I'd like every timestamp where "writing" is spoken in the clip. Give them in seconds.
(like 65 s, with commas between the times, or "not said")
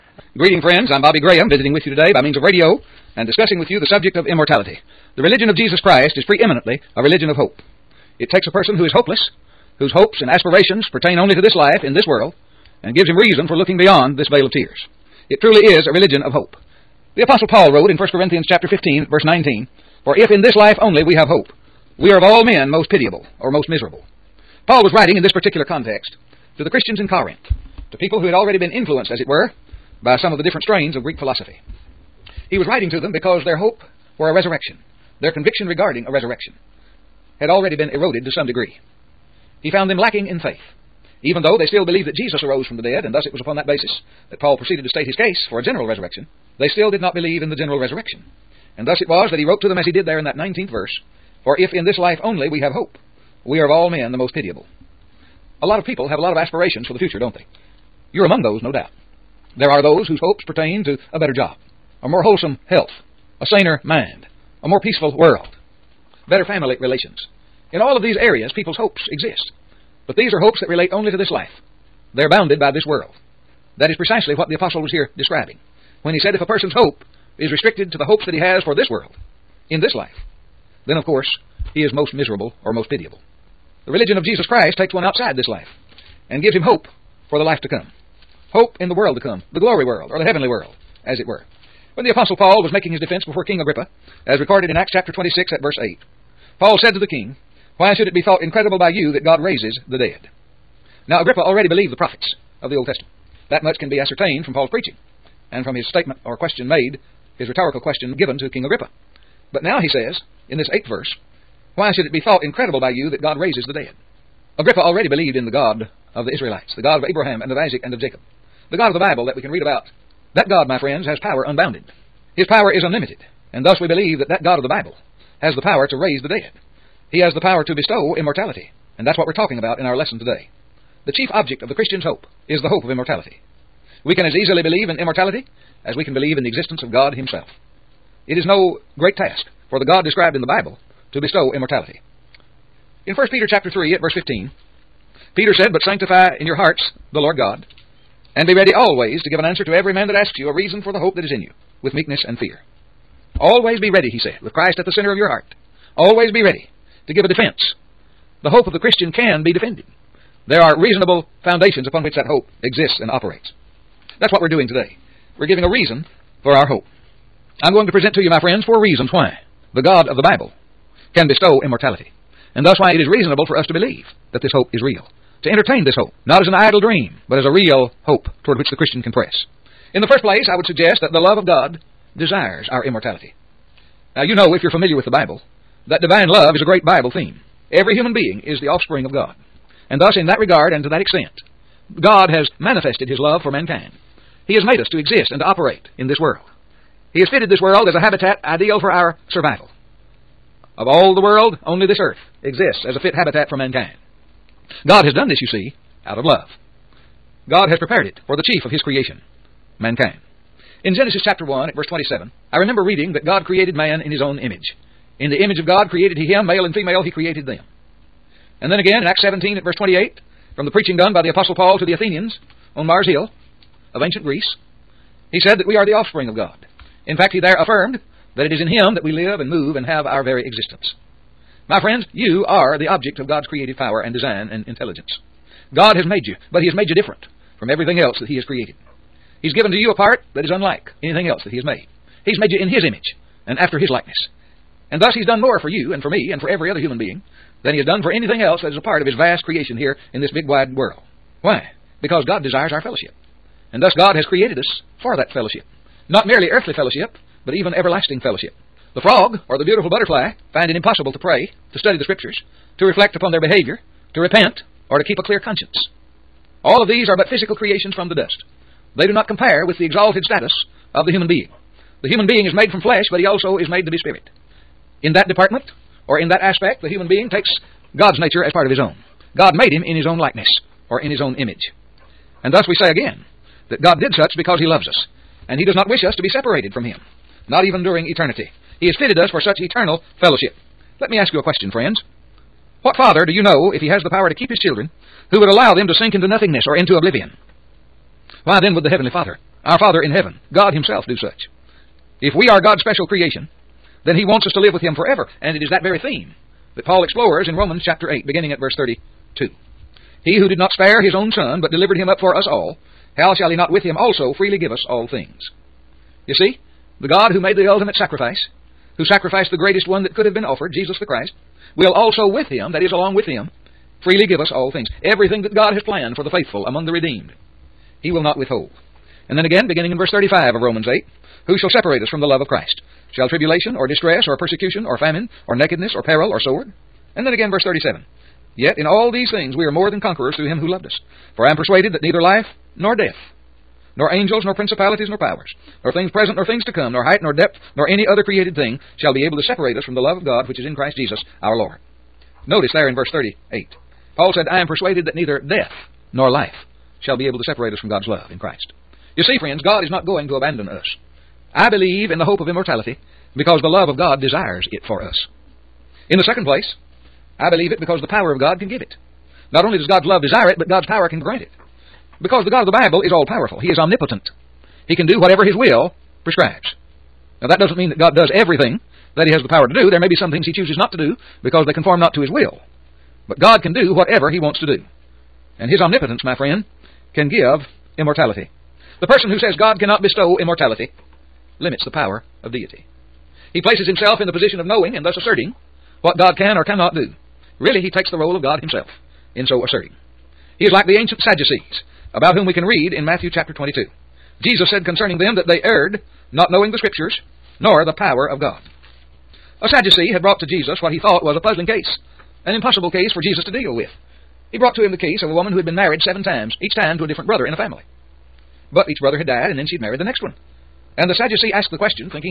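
24 s, 32 s.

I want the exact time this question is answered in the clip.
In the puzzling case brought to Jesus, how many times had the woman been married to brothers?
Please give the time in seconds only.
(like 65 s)
416 s.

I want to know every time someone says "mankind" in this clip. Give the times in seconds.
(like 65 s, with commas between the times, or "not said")
193 s, 203 s, 209 s.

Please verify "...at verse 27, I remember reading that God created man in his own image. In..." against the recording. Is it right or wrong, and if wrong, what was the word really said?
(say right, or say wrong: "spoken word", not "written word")
right.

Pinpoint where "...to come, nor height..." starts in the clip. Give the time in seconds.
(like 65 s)
346 s.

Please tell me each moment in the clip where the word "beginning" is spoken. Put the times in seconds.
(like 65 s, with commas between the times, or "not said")
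308 s, 329 s.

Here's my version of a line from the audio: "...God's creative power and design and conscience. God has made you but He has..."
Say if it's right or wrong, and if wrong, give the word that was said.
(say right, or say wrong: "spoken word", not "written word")
wrong: "intelligence", not "conscience".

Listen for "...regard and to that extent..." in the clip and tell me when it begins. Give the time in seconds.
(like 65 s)
190 s.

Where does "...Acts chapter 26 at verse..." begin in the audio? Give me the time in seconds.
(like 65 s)
94 s.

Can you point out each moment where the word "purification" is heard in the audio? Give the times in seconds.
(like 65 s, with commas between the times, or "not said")
not said.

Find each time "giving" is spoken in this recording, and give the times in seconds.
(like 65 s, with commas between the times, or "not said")
165 s.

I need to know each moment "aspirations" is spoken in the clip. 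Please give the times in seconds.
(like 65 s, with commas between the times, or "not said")
10 s, 56 s.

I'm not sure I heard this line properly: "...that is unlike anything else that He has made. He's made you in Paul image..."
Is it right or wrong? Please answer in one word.
wrong.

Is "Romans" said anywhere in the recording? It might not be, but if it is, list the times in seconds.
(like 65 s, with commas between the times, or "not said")
307 s, 330 s.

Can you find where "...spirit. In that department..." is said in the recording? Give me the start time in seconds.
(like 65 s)
273 s.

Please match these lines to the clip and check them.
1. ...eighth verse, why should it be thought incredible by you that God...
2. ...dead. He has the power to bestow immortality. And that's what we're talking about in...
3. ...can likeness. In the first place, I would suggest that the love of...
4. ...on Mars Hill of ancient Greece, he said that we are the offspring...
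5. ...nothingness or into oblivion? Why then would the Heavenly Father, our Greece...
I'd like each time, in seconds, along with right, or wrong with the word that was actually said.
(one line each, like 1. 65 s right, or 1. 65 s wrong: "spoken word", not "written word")
1. 110 s right
2. 126 s right
3. 179 s wrong: "press", not "likeness"
4. 222 s right
5. 296 s wrong: "Father", not "Greece".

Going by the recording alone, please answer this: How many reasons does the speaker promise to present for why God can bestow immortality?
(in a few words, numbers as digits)
4.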